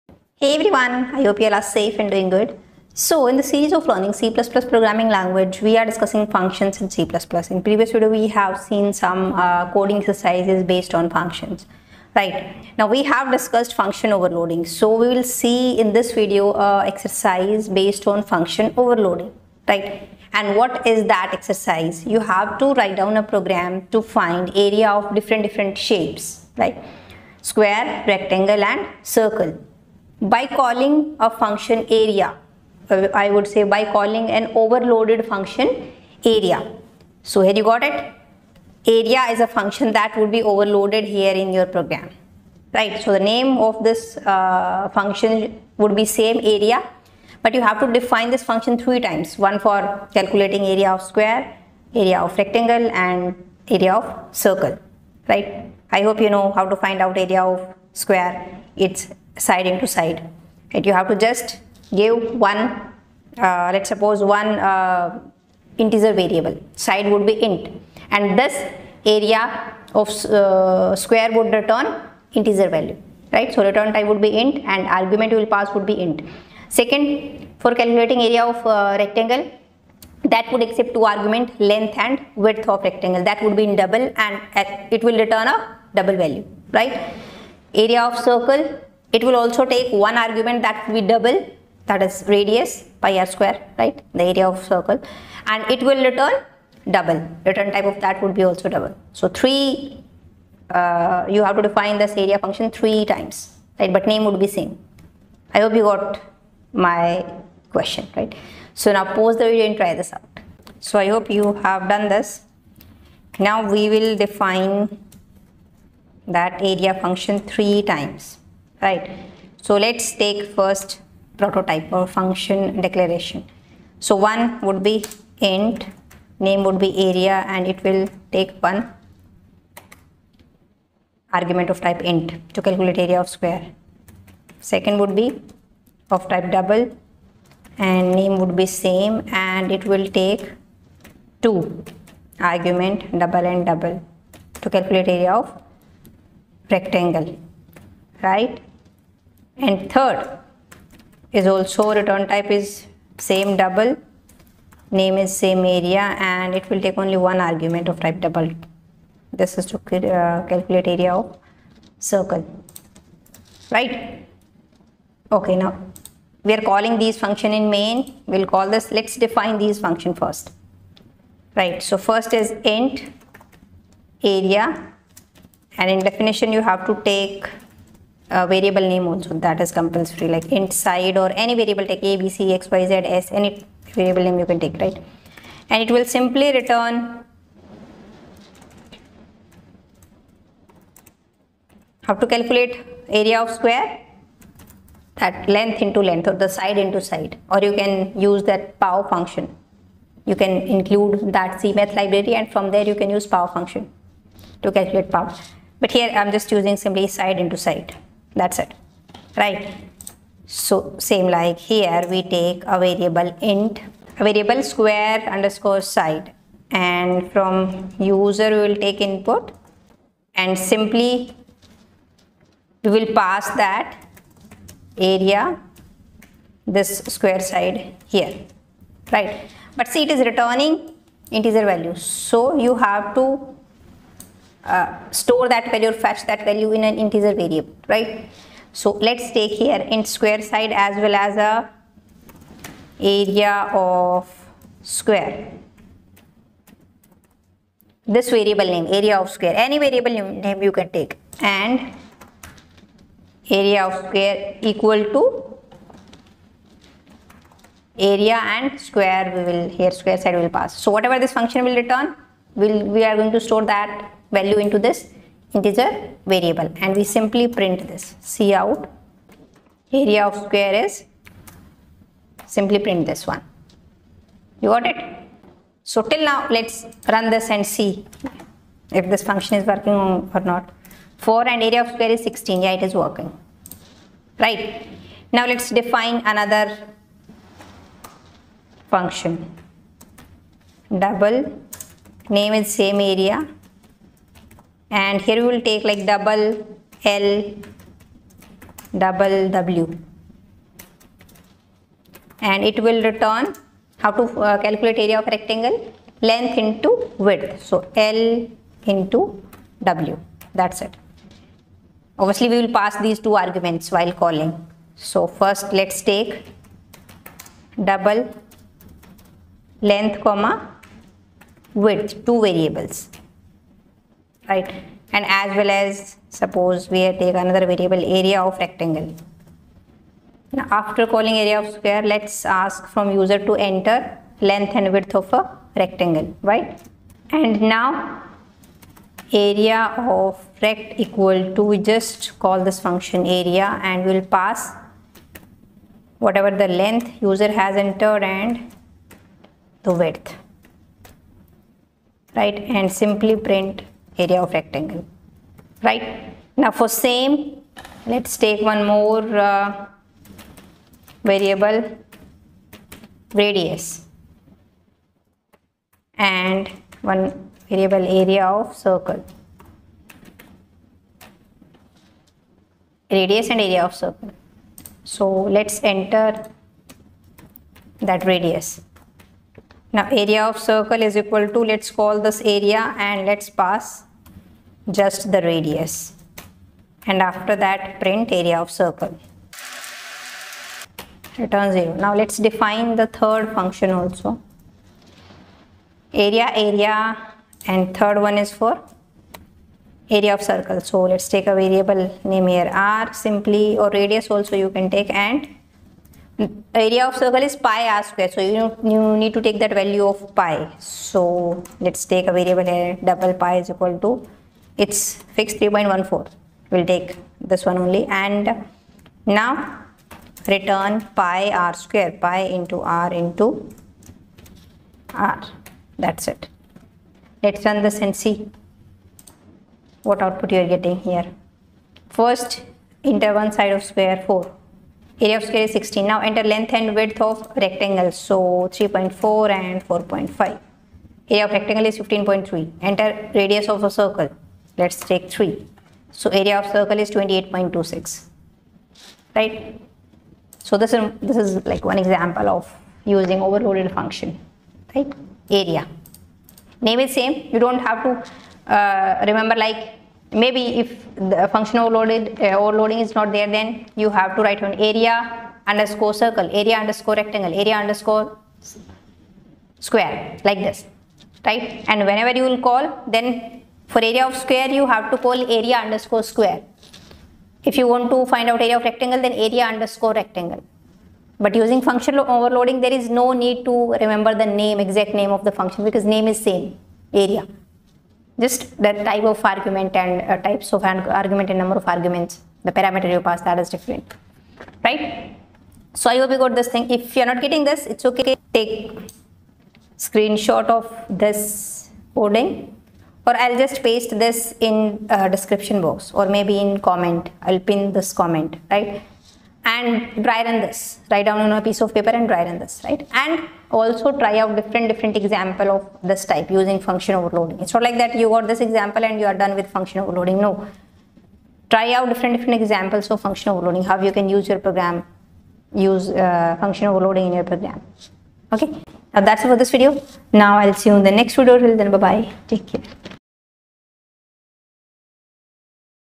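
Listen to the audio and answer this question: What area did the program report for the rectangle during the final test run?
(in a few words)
15.3.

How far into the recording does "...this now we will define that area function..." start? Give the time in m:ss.
1:52.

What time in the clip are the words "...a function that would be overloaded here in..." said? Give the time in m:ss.
0:39.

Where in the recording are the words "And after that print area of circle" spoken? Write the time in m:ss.
6:27.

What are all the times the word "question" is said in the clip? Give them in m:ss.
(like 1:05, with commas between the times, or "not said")
1:47.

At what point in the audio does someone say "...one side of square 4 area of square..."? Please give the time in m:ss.
7:13.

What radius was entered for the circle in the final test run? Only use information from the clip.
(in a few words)
3.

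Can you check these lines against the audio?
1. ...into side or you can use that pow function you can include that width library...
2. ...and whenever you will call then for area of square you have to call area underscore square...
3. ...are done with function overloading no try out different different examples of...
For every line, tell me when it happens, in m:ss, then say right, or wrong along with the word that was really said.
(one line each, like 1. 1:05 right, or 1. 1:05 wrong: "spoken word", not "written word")
1. 3:16 wrong: "cmath", not "width"
2. 7:51 right
3. 8:39 right.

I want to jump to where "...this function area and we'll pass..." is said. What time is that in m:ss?
5:42.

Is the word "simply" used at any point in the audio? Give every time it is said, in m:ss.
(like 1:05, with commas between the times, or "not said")
3:06, 3:26, 3:40, 4:27, 4:32, 5:52, 6:43.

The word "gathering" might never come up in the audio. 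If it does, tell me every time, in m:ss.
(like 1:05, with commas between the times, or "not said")
not said.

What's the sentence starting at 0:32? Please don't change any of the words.
I would say by calling an overloaded function area.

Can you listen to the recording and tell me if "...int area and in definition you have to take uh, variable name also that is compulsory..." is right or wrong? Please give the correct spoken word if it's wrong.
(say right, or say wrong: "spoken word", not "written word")
right.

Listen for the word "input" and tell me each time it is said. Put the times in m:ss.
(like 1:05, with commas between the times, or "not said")
3:38.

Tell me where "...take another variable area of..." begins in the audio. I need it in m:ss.
5:27.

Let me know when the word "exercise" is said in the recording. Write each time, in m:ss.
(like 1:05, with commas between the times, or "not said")
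0:09, 0:16, 0:21.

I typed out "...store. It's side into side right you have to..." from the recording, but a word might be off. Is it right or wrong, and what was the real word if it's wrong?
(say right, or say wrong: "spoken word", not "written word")
wrong: "square", not "store".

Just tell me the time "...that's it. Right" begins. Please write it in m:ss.
3:28.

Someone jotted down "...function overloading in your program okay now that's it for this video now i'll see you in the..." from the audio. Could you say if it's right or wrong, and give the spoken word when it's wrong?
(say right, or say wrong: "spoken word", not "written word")
right.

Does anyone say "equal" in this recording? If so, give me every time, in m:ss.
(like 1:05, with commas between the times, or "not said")
4:14, 5:40, 6:21, 6:53.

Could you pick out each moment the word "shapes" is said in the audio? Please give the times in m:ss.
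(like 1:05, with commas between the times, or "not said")
0:25.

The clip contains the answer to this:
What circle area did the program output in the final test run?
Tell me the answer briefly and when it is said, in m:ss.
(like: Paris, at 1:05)
28.26, at 7:27.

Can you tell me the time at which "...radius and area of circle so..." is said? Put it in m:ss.
6:13.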